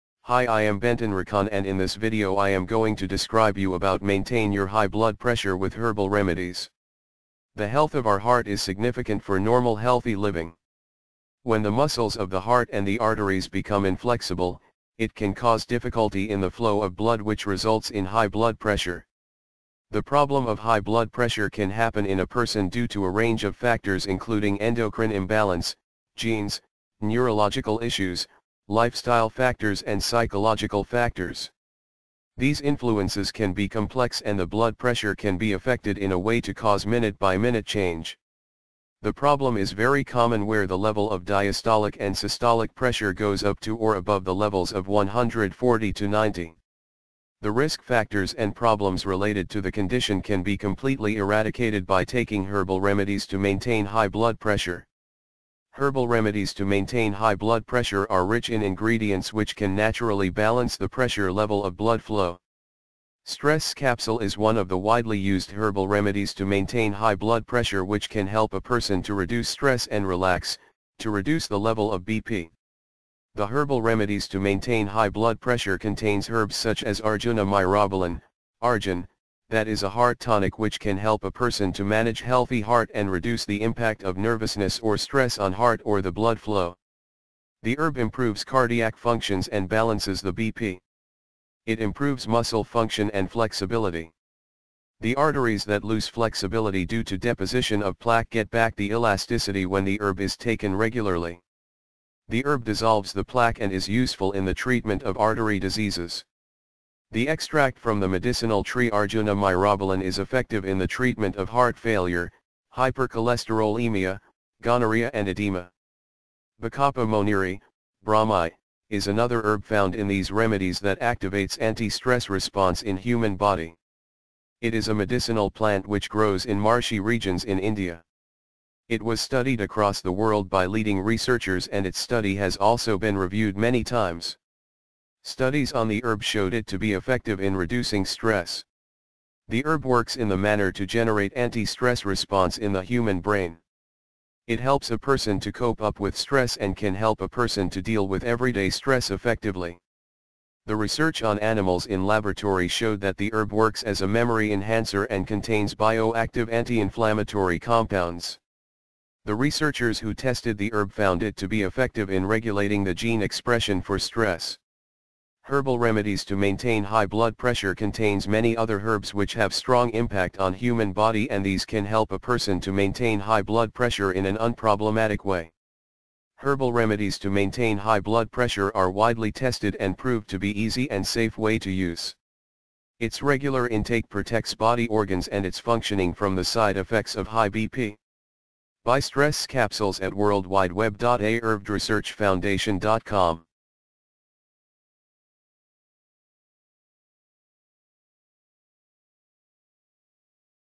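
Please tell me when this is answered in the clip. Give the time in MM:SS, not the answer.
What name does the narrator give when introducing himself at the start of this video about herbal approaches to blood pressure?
00:00.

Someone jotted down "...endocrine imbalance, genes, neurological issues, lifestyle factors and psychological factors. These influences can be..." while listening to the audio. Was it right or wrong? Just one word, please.
right.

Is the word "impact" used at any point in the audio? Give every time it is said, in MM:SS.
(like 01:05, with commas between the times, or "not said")
01:23, 02:49.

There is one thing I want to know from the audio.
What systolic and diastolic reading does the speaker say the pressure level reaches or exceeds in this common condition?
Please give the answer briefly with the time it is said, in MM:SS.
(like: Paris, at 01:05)
140 to 90, at 00:44.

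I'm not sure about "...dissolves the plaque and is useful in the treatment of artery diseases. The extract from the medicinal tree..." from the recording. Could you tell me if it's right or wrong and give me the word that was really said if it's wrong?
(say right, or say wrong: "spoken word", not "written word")
right.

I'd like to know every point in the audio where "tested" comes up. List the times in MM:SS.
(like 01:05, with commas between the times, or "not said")
02:40, 02:59.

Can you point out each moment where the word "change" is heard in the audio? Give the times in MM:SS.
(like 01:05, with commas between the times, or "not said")
00:37.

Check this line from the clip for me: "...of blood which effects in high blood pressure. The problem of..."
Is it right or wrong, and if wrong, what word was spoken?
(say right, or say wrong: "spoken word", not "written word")
wrong: "results", not "effects".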